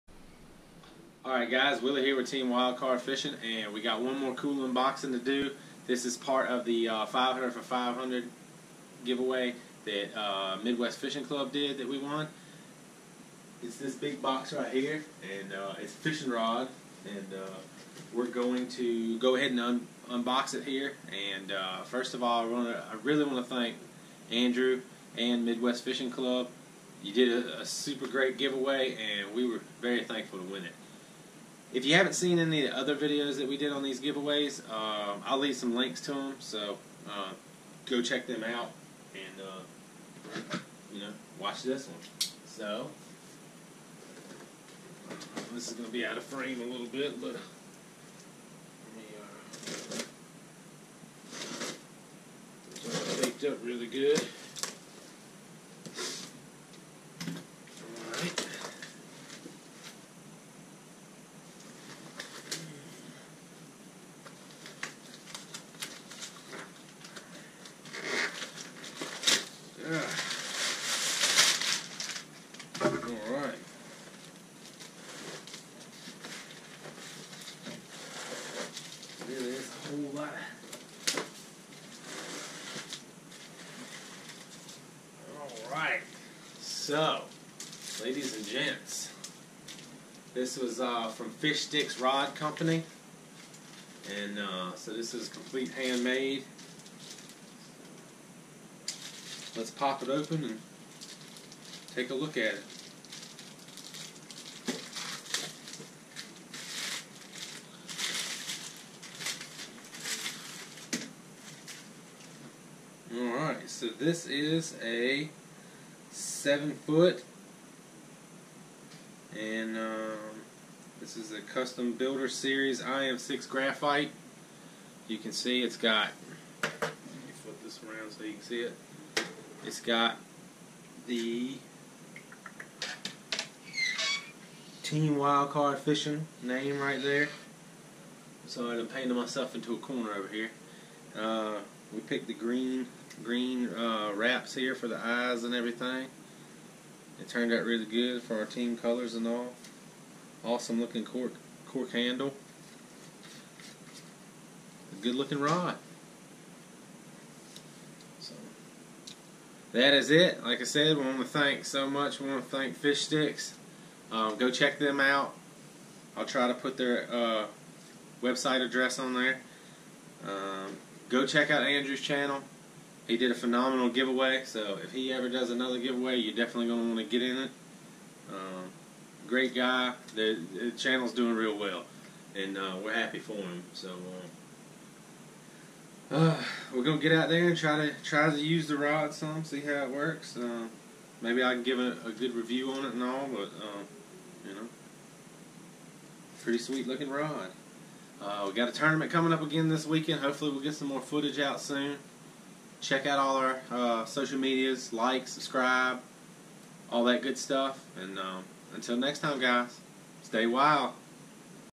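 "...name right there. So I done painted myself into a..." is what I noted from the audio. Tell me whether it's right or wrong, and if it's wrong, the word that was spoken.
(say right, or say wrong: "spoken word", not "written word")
right.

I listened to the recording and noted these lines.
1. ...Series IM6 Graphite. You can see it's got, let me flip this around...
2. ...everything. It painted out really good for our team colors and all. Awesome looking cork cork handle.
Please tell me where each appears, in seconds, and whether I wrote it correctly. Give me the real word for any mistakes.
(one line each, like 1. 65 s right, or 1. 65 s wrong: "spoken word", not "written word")
1. 122 s right
2. 145 s wrong: "turned", not "painted".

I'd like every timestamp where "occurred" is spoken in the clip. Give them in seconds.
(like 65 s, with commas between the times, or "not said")
not said.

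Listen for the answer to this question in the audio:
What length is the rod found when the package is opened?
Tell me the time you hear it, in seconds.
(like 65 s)
116 s.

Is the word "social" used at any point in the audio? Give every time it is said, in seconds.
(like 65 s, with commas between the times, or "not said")
204 s.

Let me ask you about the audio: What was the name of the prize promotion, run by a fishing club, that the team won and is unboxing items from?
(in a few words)
500 for 500.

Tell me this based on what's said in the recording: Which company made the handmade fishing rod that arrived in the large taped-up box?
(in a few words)
Fish Stix Rod Company.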